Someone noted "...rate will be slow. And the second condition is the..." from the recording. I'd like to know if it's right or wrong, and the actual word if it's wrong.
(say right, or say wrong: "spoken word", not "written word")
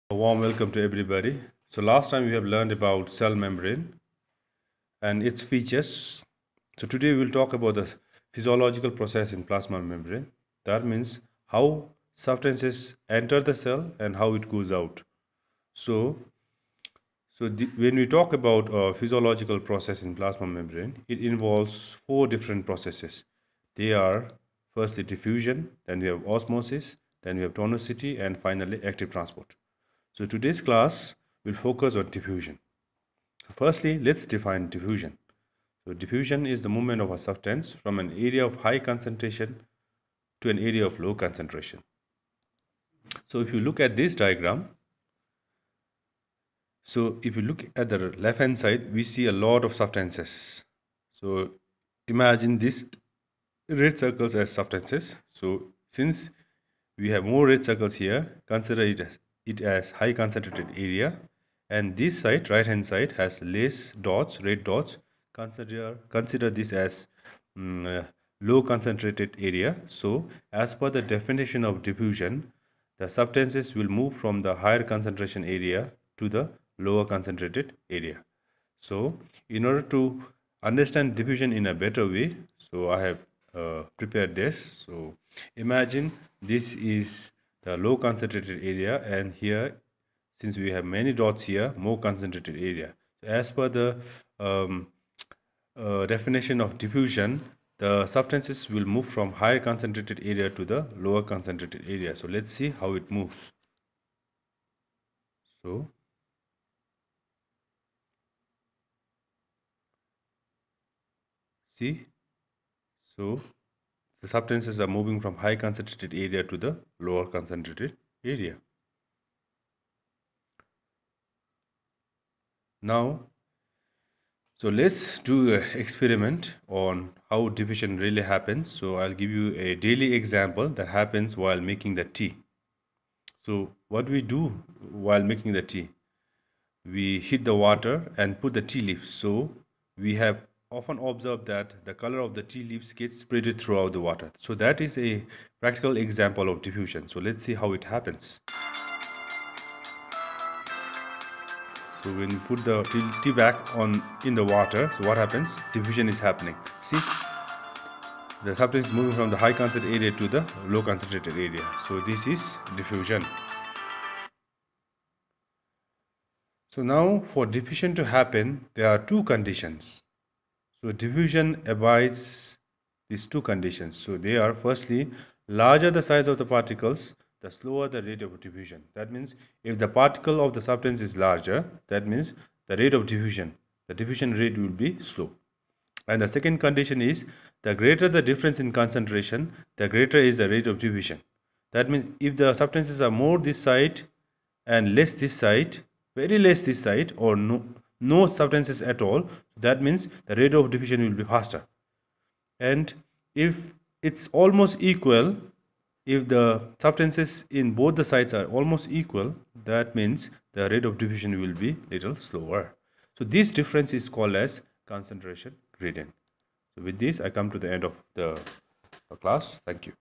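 right.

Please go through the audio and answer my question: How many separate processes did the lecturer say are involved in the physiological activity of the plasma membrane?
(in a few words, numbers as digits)
4.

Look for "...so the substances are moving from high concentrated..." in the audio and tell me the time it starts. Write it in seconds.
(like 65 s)
113 s.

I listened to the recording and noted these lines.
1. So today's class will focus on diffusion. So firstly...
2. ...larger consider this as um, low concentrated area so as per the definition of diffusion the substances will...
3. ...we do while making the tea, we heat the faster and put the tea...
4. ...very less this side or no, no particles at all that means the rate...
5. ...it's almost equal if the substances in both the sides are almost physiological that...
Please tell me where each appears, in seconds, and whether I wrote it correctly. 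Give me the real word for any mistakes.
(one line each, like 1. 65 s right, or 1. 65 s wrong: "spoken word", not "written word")
1. 30 s right
2. 65 s wrong: "consider", not "larger"
3. 134 s wrong: "water", not "faster"
4. 196 s wrong: "substances", not "particles"
5. 204 s wrong: "equal", not "physiological".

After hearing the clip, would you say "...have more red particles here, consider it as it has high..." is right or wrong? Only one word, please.
wrong.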